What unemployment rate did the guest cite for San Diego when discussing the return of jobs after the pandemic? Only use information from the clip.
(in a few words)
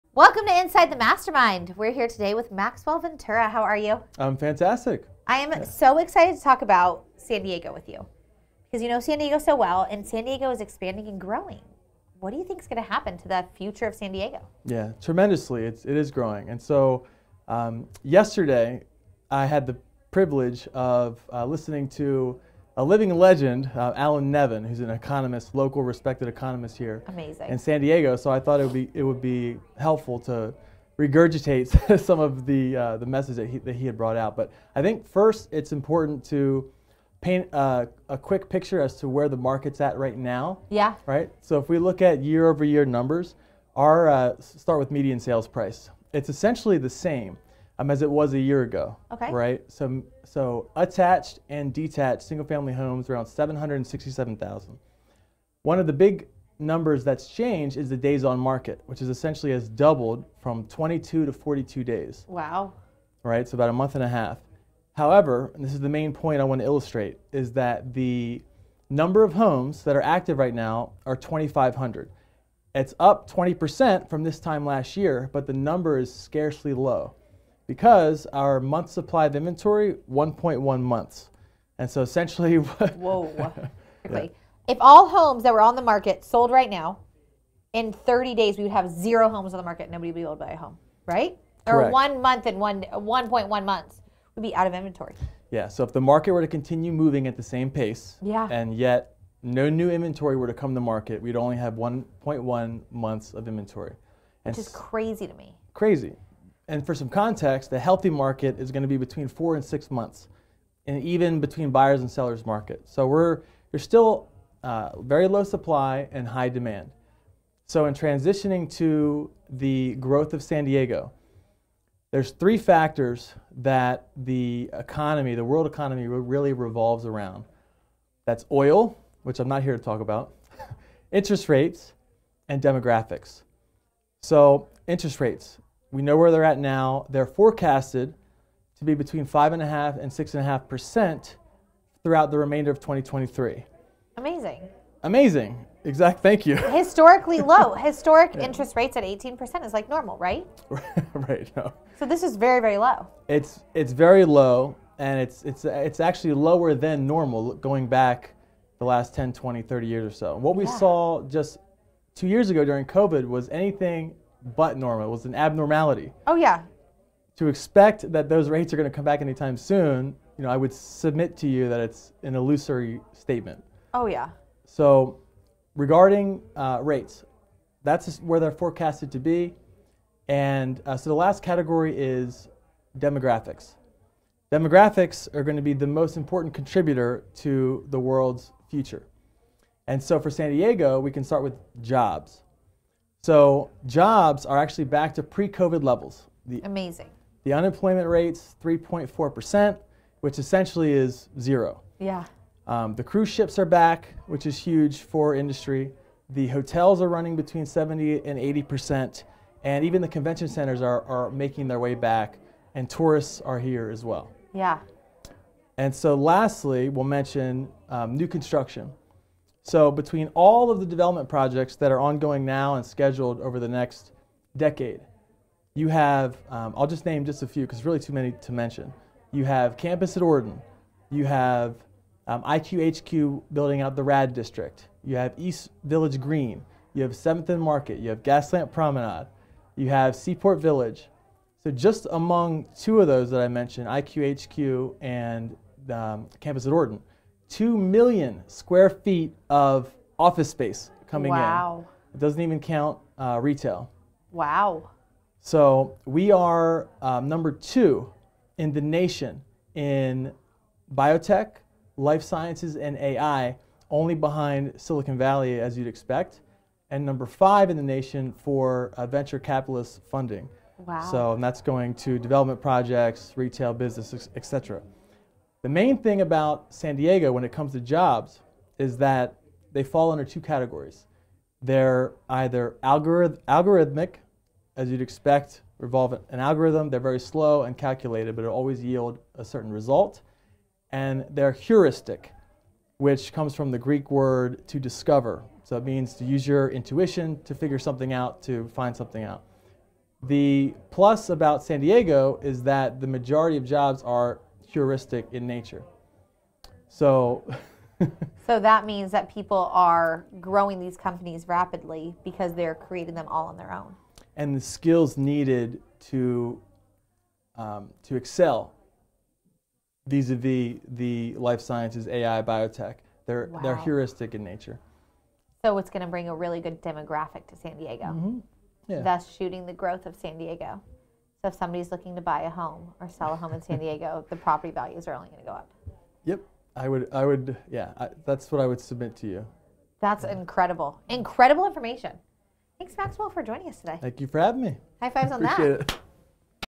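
3.4%.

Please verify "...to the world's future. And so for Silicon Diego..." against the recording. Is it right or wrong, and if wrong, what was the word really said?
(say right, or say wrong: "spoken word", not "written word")
wrong: "San", not "Silicon".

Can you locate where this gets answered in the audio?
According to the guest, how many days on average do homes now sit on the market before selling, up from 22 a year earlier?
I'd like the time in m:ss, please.
1:01.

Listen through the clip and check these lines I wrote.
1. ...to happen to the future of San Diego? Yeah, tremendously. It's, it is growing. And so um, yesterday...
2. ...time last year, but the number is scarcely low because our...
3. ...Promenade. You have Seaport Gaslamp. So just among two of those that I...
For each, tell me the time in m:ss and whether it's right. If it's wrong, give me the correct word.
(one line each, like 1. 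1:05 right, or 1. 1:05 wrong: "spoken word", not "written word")
1. 0:12 right
2. 1:14 right
3. 3:58 wrong: "Village", not "Gaslamp".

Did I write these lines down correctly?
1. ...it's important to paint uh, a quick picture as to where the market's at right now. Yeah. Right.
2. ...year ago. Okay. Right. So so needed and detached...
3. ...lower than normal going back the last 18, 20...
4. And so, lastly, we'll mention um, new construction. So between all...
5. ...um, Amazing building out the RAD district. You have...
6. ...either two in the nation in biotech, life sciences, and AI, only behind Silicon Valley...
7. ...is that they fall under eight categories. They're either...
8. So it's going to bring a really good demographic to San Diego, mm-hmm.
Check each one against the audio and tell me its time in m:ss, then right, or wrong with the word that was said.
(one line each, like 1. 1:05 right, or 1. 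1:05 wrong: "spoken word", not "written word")
1. 0:35 right
2. 0:48 wrong: "attached", not "needed"
3. 2:36 wrong: "10", not "18"
4. 3:35 right
5. 3:52 wrong: "IQHQ", not "Amazing"
6. 4:17 wrong: "number", not "either"
7. 4:38 wrong: "two", not "eight"
8. 5:25 right.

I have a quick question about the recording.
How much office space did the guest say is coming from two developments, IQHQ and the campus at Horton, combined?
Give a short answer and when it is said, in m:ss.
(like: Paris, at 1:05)
2 million square feet, at 4:07.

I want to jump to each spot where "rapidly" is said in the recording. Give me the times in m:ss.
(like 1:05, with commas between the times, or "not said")
5:11.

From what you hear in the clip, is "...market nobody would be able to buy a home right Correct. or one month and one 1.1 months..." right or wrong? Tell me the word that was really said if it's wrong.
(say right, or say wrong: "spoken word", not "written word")
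right.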